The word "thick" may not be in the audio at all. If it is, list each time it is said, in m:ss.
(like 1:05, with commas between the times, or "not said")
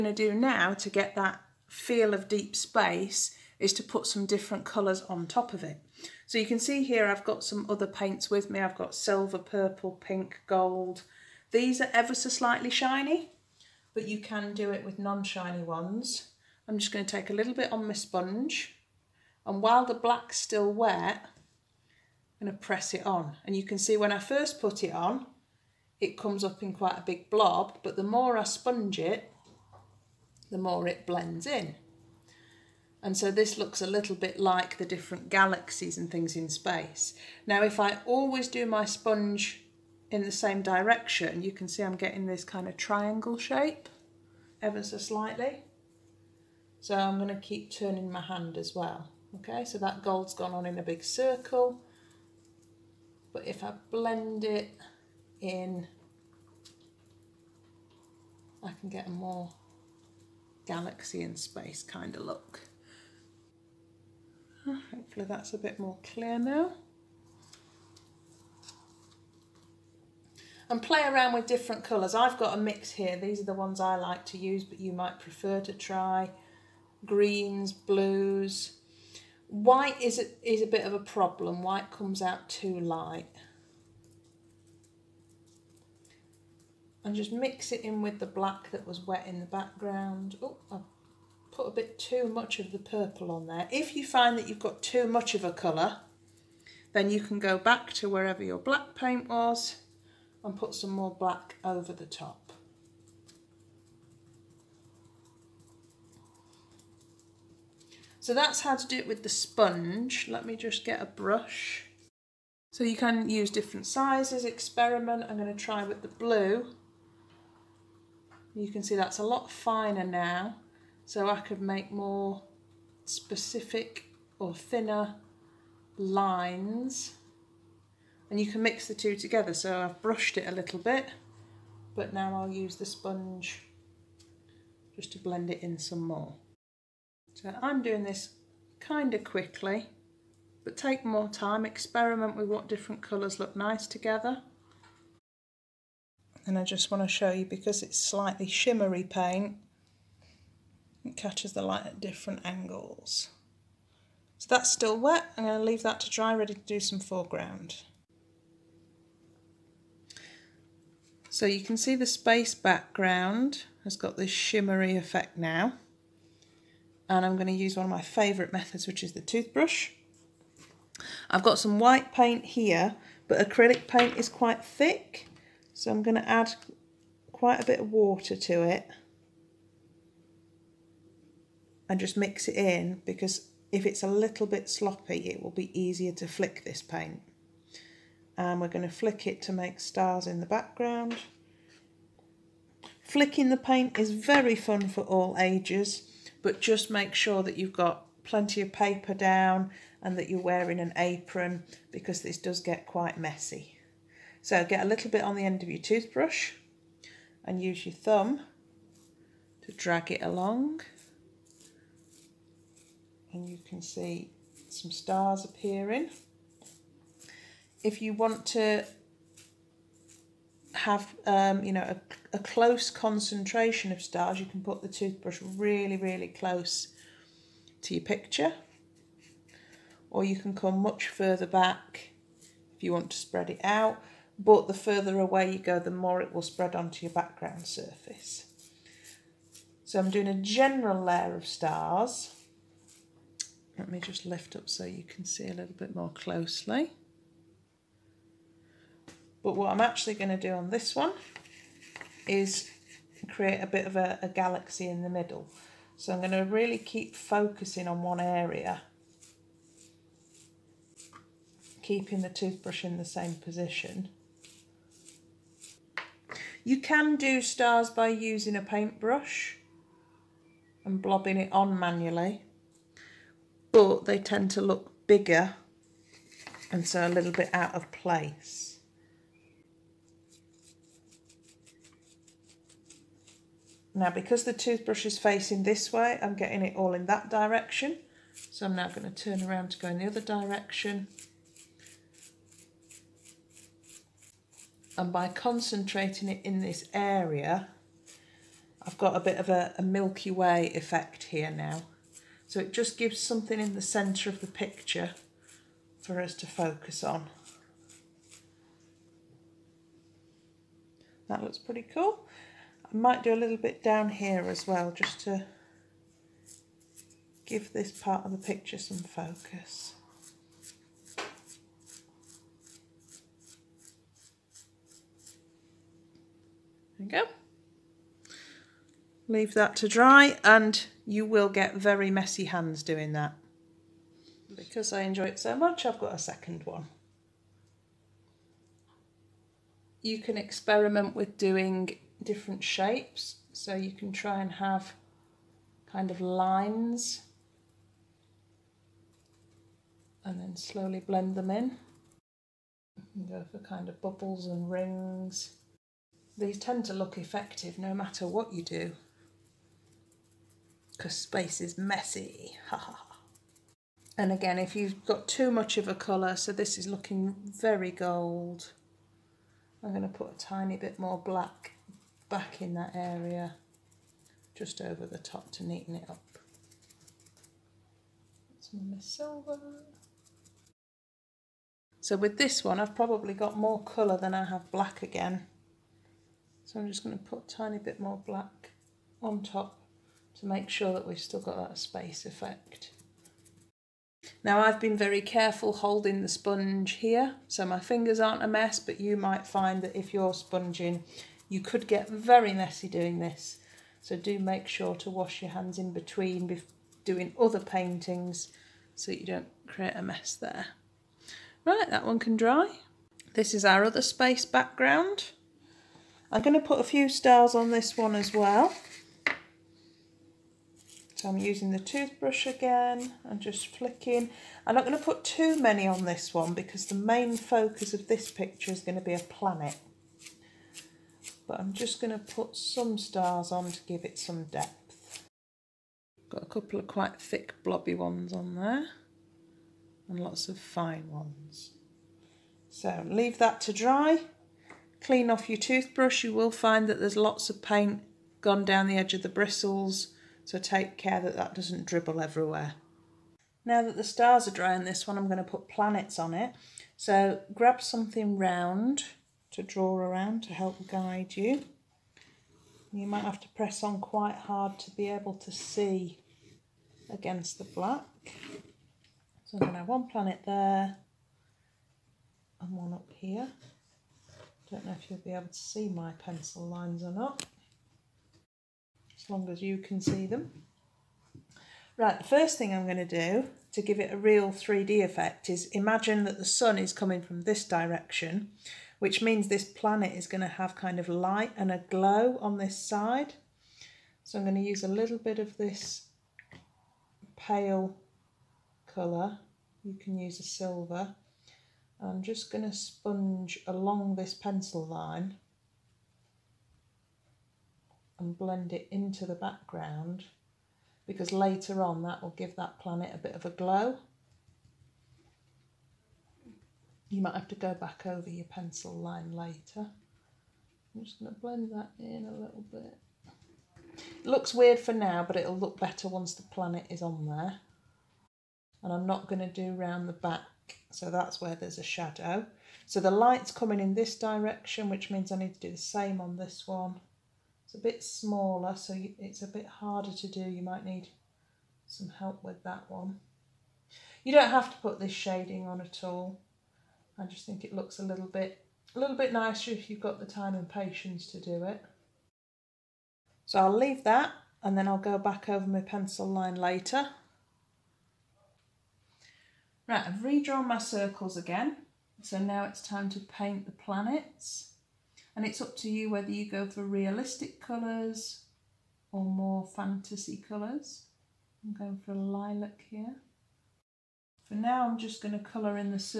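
2:54, 7:17.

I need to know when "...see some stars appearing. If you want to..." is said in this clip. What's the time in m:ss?
3:33.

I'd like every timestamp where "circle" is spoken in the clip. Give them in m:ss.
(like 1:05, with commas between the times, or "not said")
0:51, 9:20.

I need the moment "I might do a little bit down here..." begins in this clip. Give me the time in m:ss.
5:12.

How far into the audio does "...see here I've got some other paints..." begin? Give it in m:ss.
0:06.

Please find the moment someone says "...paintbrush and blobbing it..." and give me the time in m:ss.
4:28.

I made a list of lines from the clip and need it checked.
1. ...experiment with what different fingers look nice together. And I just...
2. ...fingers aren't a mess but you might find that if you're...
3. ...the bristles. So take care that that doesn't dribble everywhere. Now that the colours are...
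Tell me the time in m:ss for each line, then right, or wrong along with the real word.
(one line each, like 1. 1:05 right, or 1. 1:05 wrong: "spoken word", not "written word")
1. 2:21 wrong: "colours", not "fingers"
2. 6:37 right
3. 7:29 wrong: "stars", not "colours".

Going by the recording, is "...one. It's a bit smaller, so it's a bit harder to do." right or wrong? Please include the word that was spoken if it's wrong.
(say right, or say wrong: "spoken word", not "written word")
right.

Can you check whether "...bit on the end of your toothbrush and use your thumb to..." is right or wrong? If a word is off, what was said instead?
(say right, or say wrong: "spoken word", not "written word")
right.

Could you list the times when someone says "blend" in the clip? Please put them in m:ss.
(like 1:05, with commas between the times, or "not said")
0:31, 0:53, 2:15, 5:50, 8:28, 8:41.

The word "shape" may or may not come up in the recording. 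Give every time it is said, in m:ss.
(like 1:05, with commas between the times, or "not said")
0:43, 5:42.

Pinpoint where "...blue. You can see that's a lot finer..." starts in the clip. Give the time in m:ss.
1:56.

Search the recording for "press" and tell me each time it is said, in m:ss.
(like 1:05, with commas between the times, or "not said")
0:22, 7:43.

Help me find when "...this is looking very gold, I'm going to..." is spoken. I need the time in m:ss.
6:06.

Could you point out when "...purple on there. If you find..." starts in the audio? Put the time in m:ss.
1:32.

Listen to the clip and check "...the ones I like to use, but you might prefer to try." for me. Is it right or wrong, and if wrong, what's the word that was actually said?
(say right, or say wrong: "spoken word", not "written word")
right.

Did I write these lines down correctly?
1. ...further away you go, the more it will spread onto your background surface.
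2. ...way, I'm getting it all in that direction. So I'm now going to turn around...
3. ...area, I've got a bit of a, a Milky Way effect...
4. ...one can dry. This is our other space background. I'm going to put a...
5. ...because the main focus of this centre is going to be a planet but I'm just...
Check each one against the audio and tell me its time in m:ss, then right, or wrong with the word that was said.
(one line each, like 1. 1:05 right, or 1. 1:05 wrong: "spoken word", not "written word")
1. 3:54 right
2. 4:45 right
3. 4:56 right
4. 6:52 right
5. 7:06 wrong: "picture", not "centre".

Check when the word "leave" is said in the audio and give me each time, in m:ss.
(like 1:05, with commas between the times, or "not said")
2:35, 5:29, 7:23, 9:13.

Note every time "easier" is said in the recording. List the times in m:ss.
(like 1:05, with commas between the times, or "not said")
3:05.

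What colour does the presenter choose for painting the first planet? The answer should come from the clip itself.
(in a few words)
Lilac.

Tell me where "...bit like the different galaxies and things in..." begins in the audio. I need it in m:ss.
0:34.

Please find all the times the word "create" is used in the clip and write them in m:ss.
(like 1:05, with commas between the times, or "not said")
4:13, 6:49.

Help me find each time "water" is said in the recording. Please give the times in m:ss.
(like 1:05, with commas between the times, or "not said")
2:57.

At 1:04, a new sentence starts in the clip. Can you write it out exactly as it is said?
Ah, hopefully that's a bit more clear now.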